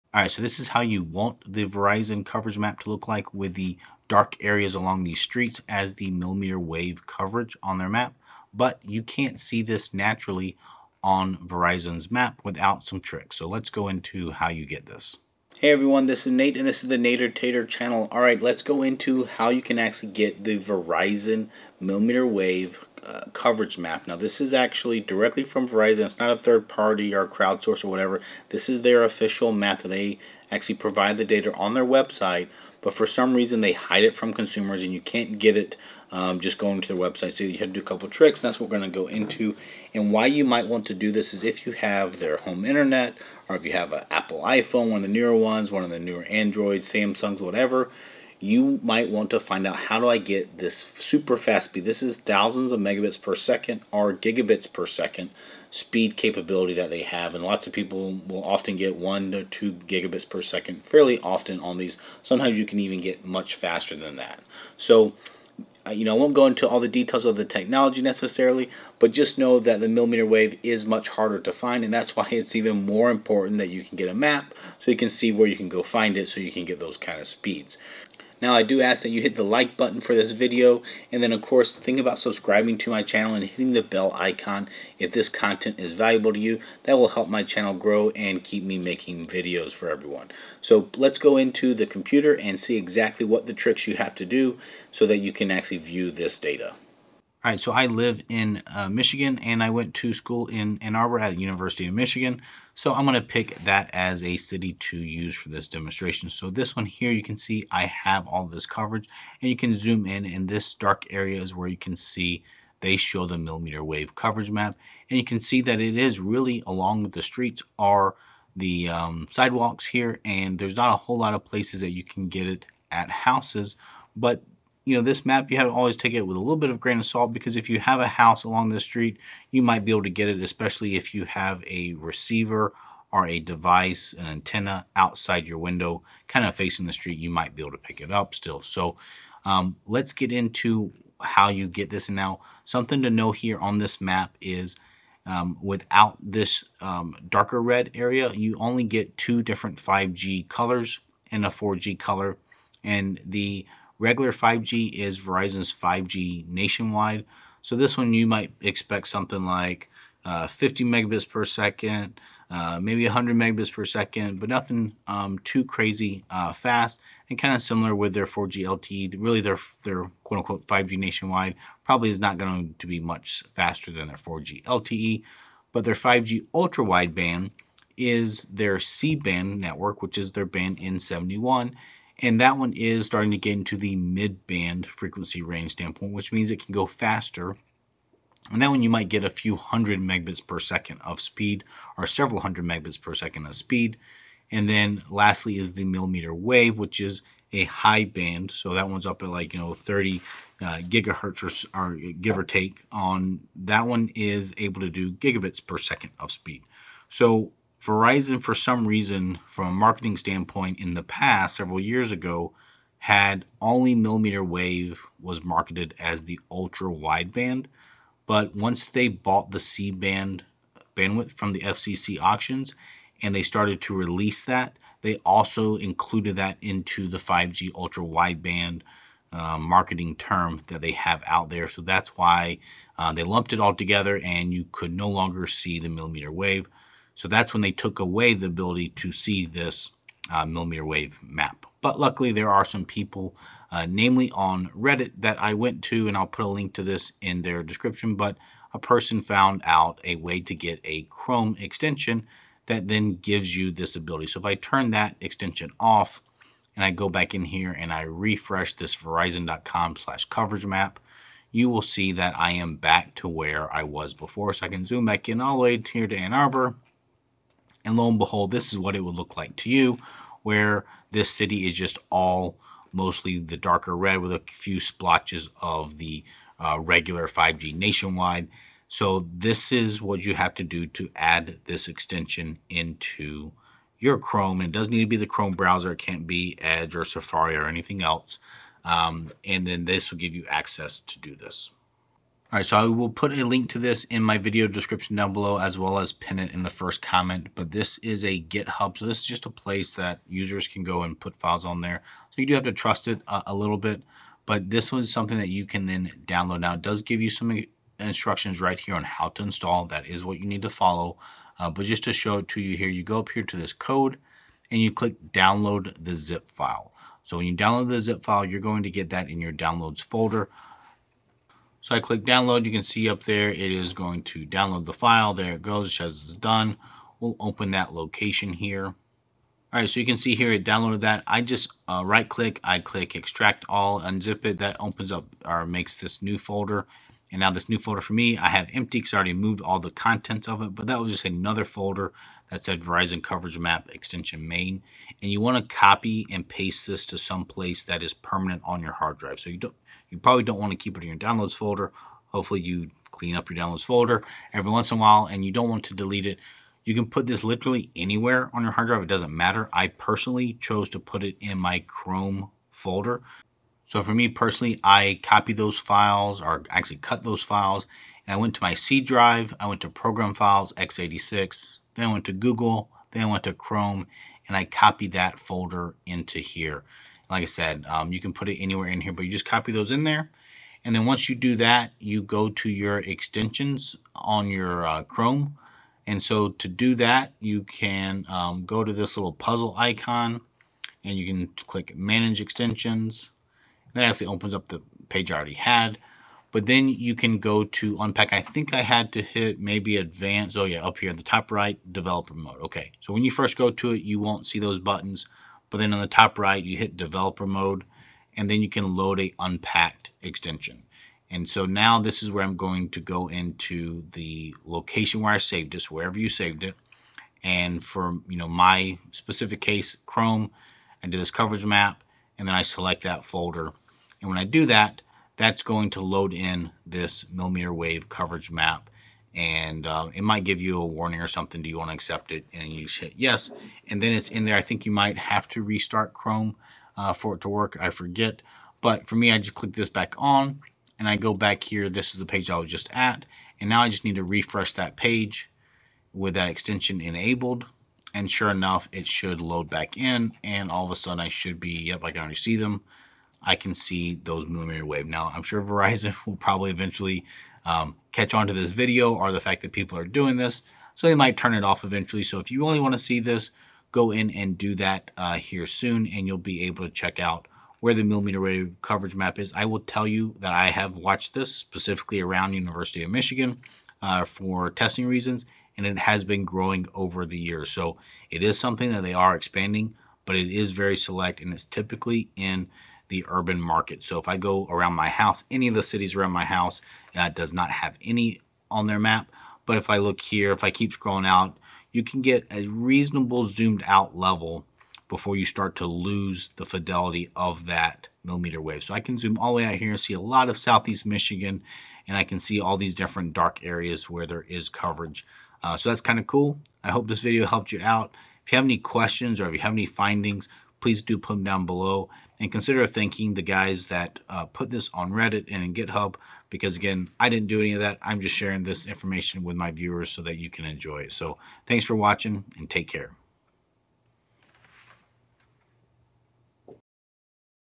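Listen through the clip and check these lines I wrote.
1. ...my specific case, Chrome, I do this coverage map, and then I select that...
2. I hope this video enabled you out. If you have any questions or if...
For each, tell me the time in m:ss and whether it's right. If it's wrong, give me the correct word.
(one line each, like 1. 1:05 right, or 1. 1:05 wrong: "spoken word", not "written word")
1. 6:58 right
2. 8:26 wrong: "helped", not "enabled".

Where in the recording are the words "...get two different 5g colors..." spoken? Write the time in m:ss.
2:28.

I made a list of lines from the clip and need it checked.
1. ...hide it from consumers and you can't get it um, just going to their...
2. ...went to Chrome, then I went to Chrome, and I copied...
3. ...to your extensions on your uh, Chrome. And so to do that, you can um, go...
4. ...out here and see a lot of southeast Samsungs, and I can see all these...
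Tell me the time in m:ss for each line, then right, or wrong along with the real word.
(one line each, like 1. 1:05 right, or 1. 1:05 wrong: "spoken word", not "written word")
1. 0:33 right
2. 6:12 wrong: "Google", not "Chrome"
3. 6:22 right
4. 8:19 wrong: "Michigan", not "Samsungs".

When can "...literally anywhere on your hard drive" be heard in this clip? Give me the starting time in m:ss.
5:57.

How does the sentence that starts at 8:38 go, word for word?
I'm just sharing this information with my viewers so that you can enjoy it.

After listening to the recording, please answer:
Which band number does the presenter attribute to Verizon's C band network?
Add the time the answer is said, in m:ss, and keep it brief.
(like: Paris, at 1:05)
N71, at 3:00.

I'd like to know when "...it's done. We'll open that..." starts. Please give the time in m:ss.
5:26.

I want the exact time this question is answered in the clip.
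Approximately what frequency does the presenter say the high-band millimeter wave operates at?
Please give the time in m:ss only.
3:19.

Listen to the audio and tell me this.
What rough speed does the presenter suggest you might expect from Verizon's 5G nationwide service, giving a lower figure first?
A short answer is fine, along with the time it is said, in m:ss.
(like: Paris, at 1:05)
50 megabits per second, at 2:40.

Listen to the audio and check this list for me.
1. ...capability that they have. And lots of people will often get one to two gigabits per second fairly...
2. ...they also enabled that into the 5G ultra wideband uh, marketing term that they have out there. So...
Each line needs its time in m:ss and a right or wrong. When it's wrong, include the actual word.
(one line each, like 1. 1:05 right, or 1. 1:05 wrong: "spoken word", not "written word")
1. 0:56 right
2. 3:45 wrong: "included", not "enabled".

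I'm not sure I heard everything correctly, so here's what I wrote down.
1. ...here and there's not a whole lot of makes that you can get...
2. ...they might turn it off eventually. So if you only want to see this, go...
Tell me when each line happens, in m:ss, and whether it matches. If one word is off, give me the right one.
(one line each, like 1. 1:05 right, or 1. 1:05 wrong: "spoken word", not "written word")
1. 1:59 wrong: "places", not "makes"
2. 7:41 right.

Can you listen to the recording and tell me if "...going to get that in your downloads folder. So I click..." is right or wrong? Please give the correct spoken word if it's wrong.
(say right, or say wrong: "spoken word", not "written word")
right.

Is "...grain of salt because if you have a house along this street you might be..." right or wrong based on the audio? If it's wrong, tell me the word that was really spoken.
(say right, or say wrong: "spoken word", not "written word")
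right.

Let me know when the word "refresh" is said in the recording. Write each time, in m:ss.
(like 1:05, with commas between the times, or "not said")
4:18, 7:24.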